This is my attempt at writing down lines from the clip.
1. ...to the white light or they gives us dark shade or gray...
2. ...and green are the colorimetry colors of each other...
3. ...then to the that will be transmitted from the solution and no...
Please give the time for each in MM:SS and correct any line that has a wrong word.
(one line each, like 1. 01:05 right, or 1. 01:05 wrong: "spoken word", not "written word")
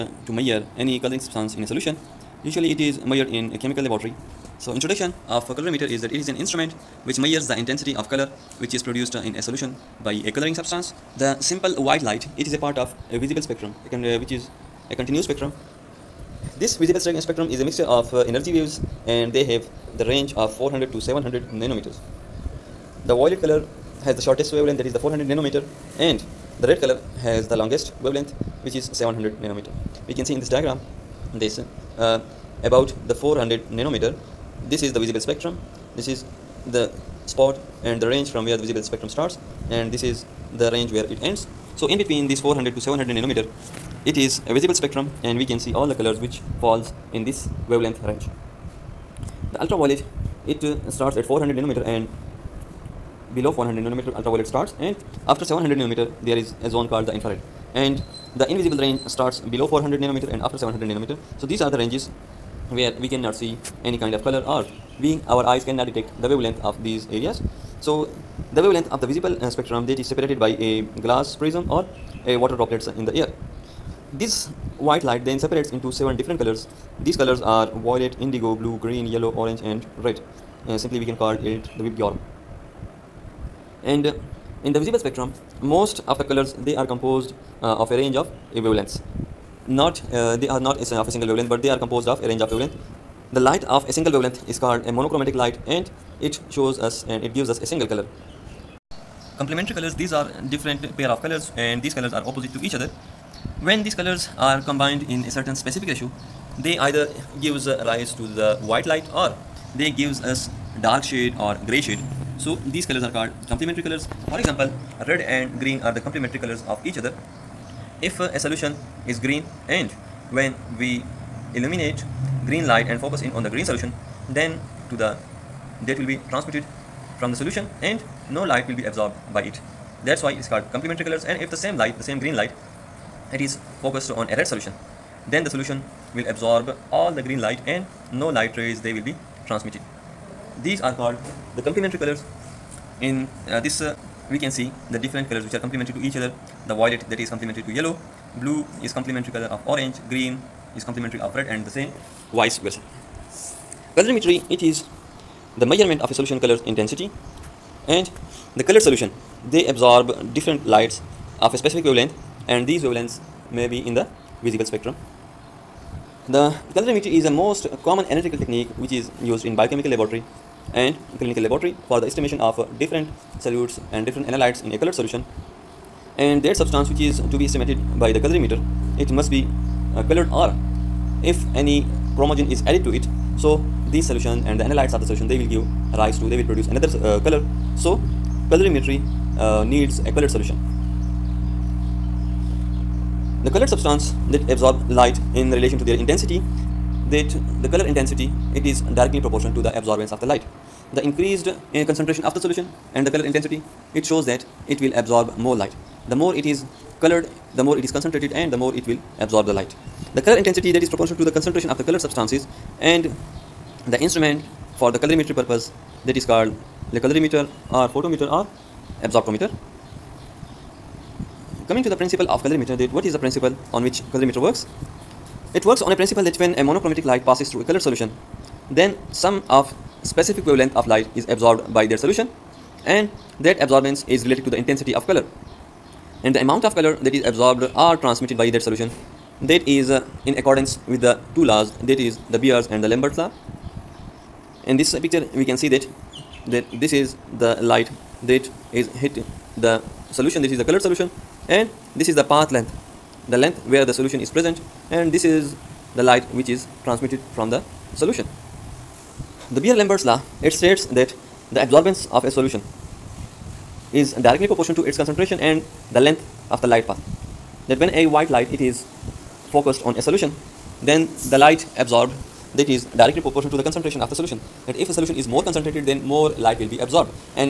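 1. 01:48 right
2. 01:55 wrong: "complementary", not "colorimetry"
3. 02:04 right.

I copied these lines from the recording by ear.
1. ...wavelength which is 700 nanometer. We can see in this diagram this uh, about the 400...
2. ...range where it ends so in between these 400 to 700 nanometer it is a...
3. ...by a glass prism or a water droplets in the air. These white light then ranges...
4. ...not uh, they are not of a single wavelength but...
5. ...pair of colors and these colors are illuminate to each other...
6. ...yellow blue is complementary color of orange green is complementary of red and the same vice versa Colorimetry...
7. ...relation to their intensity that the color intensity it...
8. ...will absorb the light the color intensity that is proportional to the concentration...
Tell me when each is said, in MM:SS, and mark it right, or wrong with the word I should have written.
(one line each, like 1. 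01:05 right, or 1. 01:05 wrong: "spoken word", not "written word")
1. 00:28 right
2. 00:40 right
3. 01:10 wrong: "separates", not "ranges"
4. 01:29 right
5. 01:40 wrong: "opposite", not "illuminate"
6. 02:27 right
7. 03:15 right
8. 03:28 right.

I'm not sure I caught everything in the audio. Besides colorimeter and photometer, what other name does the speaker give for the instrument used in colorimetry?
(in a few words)
absorptometer.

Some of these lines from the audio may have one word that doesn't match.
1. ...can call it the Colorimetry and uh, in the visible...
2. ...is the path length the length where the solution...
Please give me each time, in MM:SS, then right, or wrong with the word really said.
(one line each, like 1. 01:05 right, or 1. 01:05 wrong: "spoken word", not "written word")
1. 01:21 wrong: "Vibgyor", not "Colorimetry"
2. 04:12 right.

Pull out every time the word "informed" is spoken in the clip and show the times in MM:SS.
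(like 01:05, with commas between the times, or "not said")
not said.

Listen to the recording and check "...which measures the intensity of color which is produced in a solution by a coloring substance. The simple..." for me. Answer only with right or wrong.
right.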